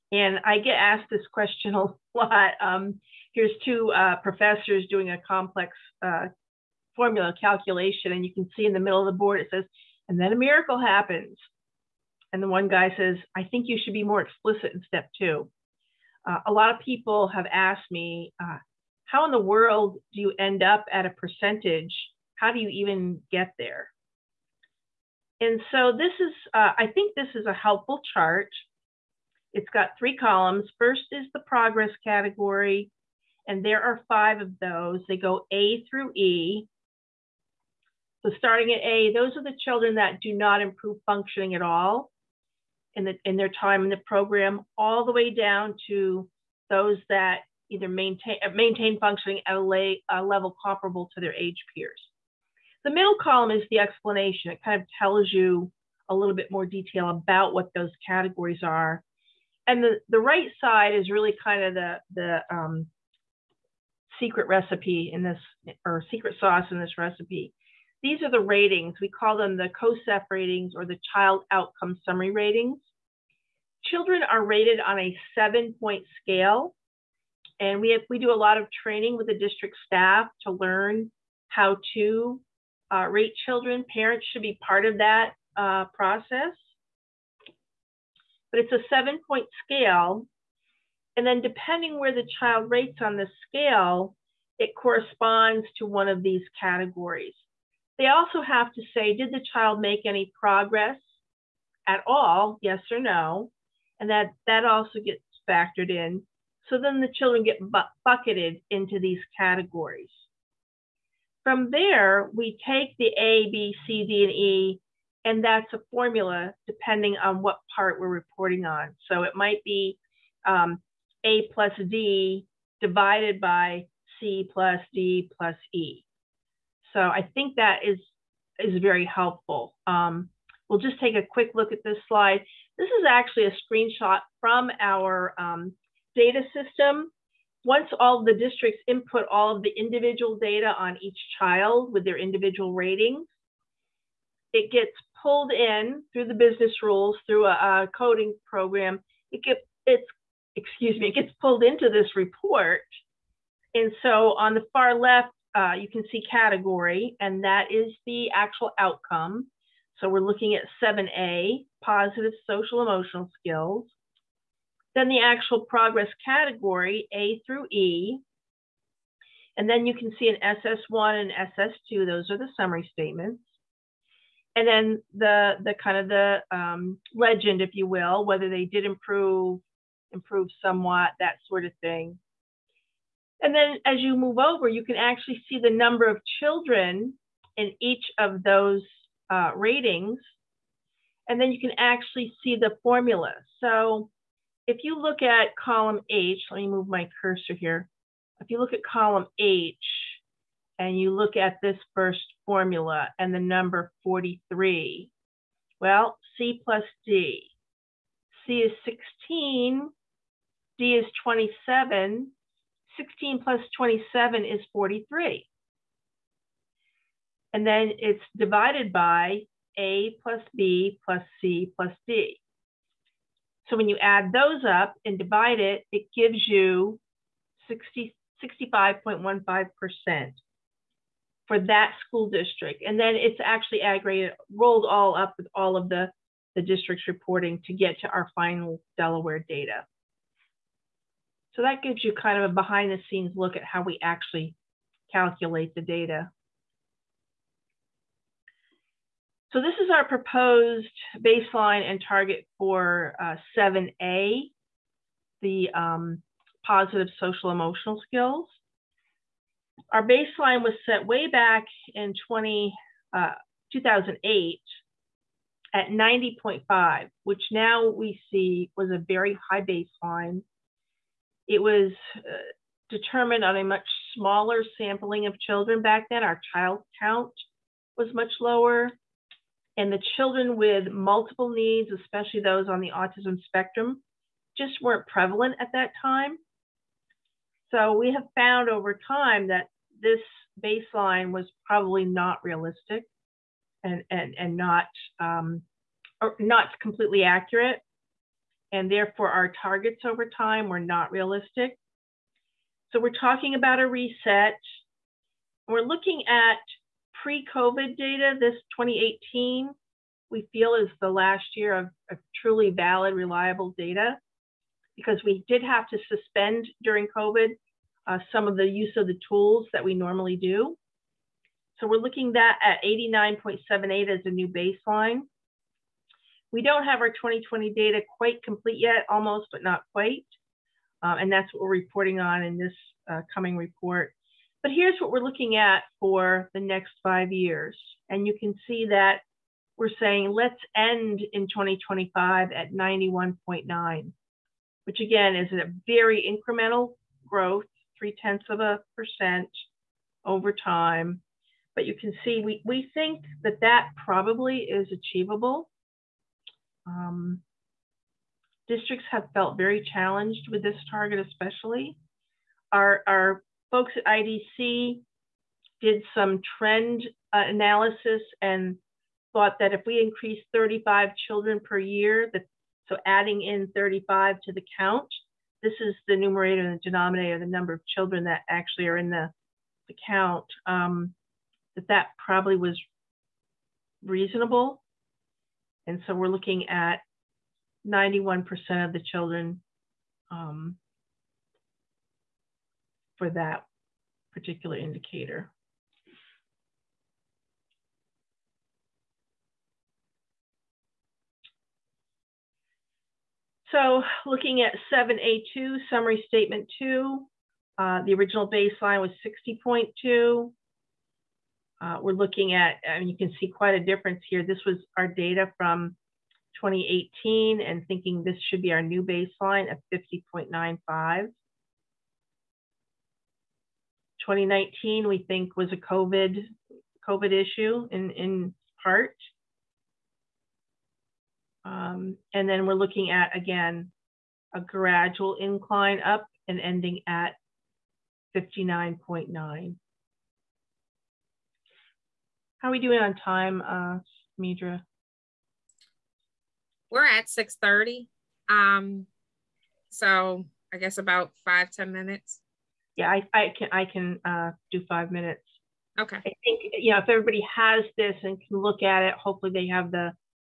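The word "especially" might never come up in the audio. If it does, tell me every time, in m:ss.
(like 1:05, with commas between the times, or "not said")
4:41, 6:01.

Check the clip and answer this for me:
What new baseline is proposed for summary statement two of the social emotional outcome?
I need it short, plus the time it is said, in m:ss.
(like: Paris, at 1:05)
50.95, at 6:59.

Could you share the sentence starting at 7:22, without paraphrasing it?
How are we doing on time, uh, Midra?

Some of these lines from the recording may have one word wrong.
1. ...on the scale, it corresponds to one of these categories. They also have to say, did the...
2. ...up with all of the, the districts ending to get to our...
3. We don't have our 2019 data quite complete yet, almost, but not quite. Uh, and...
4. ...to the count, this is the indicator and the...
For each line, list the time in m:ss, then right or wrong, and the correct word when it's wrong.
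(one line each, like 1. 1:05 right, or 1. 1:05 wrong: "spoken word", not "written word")
1. 1:32 right
2. 3:55 wrong: "reporting", not "ending"
3. 5:26 wrong: "2020", not "2019"
4. 6:14 wrong: "numerator", not "indicator".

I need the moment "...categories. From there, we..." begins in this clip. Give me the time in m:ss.
1:49.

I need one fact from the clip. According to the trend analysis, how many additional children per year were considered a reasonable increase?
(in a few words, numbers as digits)
35.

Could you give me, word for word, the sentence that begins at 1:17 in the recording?
And we, have, we do a lot of training with the district staff to learn how to uh, rate children.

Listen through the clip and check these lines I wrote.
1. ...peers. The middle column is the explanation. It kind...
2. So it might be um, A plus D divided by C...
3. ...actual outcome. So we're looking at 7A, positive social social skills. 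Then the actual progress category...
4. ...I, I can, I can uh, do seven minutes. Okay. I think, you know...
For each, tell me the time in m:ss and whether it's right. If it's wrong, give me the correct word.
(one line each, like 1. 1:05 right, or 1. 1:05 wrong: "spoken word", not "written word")
1. 0:51 right
2. 1:59 right
3. 2:38 wrong: "emotional", not "social"
4. 7:33 wrong: "five", not "seven".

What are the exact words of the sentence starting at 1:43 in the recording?
And that, that also gets factored in.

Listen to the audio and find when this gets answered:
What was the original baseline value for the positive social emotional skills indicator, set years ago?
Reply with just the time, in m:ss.
4:25.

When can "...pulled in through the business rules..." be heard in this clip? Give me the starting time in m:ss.
2:25.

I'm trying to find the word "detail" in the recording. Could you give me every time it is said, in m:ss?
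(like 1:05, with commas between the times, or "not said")
0:56.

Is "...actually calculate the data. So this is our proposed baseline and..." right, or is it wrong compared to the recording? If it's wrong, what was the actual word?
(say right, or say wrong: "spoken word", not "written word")
right.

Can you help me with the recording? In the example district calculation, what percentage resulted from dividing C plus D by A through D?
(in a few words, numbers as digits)
65.15%.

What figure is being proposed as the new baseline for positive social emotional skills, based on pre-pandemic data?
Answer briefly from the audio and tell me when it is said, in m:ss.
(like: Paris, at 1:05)
89.78, at 5:22.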